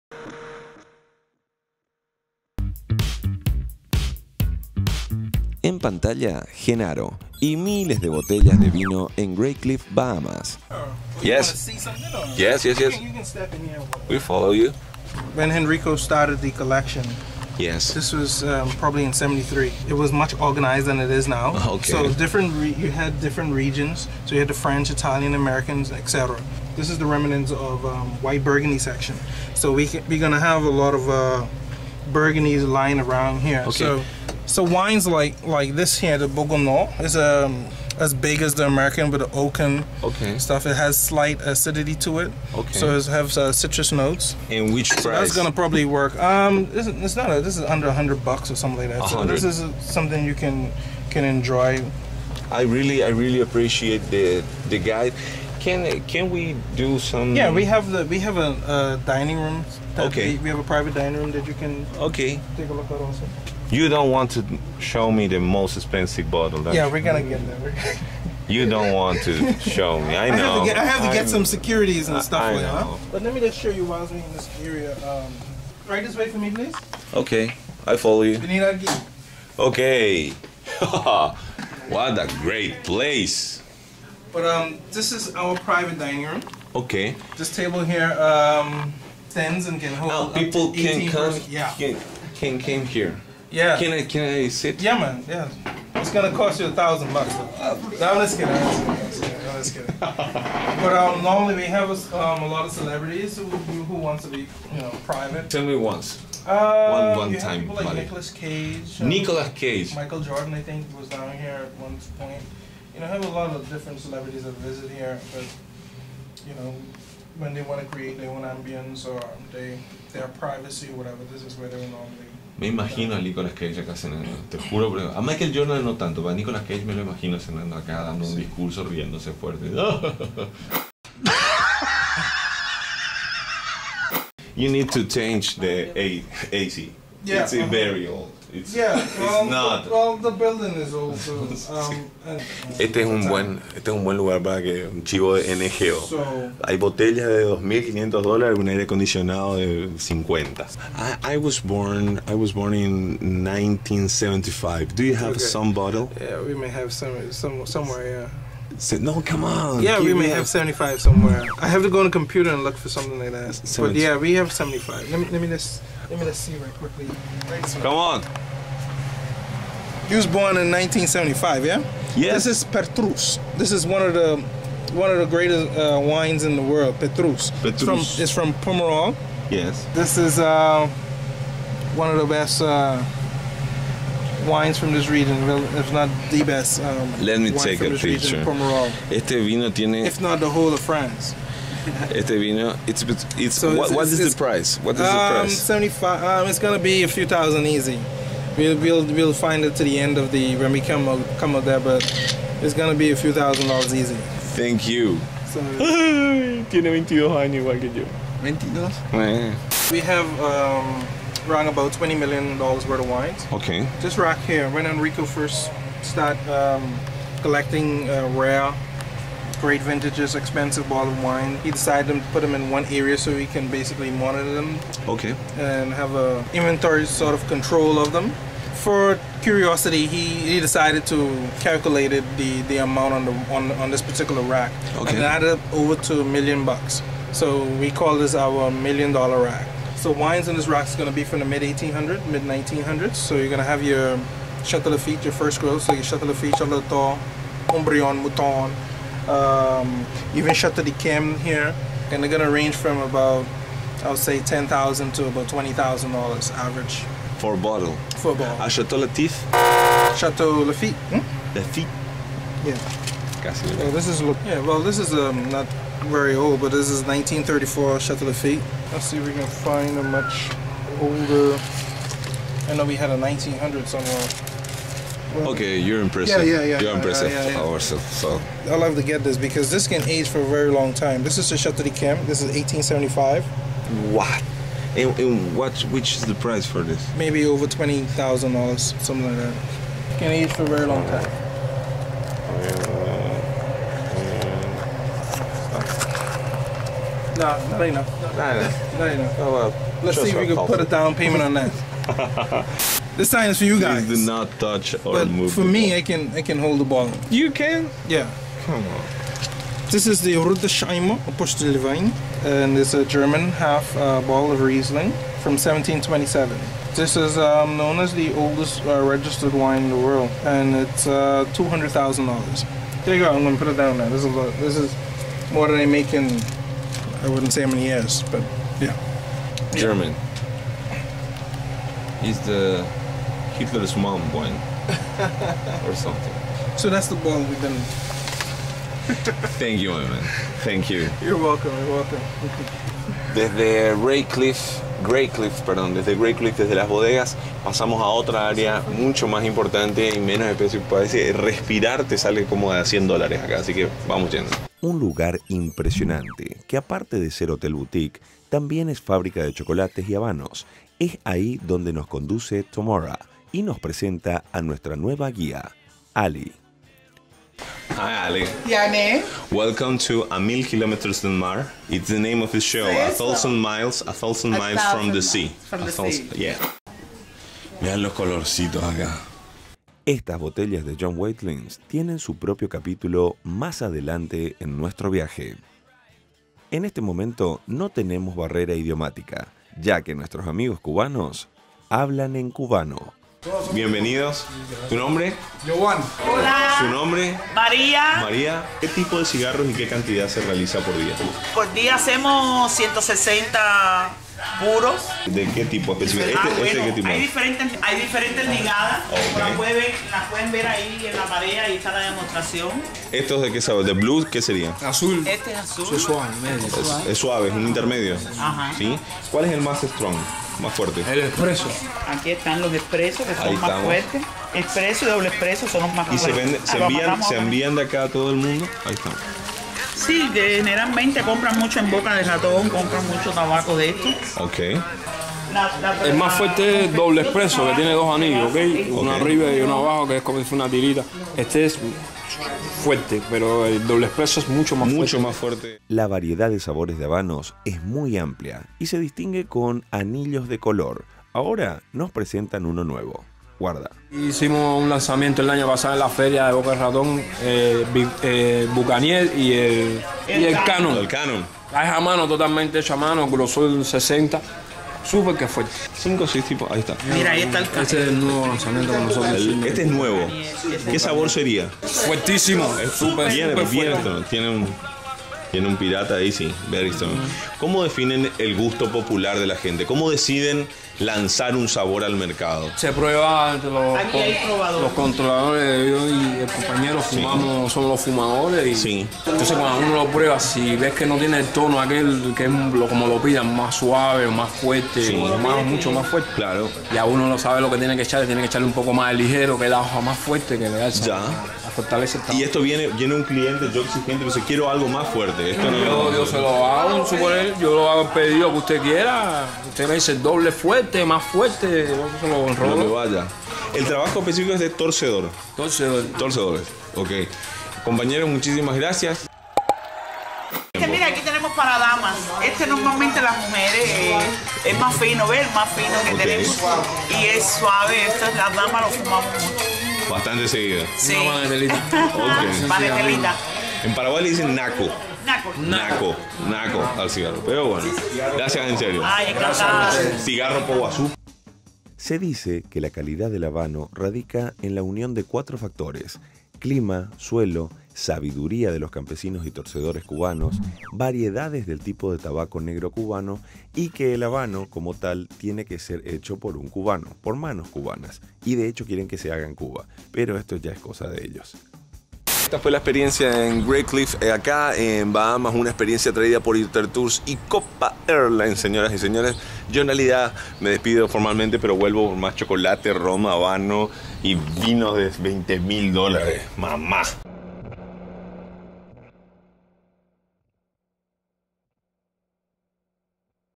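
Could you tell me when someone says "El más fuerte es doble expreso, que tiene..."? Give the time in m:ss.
7:16.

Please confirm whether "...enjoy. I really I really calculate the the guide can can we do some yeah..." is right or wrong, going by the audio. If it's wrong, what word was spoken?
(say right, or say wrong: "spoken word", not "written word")
wrong: "appreciate", not "calculate".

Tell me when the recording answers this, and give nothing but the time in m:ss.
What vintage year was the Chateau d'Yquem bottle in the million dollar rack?
4:42.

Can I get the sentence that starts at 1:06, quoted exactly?
That's yeah, we're gonna get there.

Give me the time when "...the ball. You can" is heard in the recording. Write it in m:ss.
5:06.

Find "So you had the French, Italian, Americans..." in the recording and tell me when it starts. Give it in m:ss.
0:24.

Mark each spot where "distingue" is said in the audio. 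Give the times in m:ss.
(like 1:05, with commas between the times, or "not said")
7:28.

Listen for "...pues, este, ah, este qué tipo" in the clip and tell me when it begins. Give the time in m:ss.
6:45.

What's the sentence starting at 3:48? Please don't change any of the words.
For curiosity, he, he decided to calculate it, the, the amount on the on, on this particular rack okay.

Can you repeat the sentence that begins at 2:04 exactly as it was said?
Pero a Michael Jordan no tanto, pero a Nicolas Cage me lo imagino cenando acá, dando un discurso, riéndose fuerte.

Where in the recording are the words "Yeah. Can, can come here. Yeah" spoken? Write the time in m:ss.
1:31.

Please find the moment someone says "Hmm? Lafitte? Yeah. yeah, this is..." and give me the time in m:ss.
4:21.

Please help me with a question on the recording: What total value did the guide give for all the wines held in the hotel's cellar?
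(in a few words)
20 million dollars.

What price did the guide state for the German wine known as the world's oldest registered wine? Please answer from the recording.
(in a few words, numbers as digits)
$200,000.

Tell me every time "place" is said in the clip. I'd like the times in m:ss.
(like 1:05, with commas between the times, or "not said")
1:22.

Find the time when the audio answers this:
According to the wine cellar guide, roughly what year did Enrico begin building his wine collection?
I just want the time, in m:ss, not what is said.
0:19.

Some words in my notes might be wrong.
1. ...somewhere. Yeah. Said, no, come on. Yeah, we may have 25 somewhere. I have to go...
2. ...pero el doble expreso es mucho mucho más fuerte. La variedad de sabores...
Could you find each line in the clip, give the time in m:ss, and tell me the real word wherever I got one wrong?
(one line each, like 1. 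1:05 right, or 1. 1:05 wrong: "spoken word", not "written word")
1. 2:37 wrong: "75", not "25"
2. 7:23 right.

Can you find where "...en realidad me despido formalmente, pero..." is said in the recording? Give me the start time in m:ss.
9:29.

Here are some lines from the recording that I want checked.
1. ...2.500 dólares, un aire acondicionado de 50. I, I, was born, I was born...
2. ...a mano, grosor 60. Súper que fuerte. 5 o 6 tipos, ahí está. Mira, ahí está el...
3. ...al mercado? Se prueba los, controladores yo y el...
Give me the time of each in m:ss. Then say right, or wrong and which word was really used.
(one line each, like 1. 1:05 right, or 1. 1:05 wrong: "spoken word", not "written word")
1. 2:27 right
2. 7:42 right
3. 8:02 right.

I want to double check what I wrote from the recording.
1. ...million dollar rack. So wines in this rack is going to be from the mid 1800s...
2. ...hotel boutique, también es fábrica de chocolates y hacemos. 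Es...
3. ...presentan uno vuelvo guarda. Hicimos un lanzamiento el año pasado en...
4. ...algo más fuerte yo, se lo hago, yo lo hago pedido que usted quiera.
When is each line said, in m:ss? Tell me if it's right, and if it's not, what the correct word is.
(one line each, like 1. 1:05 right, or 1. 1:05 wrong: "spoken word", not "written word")
1. 3:58 right
2. 5:57 wrong: "habanos", not "hacemos"
3. 7:32 wrong: "nuevo", not "vuelvo"
4. 8:24 right.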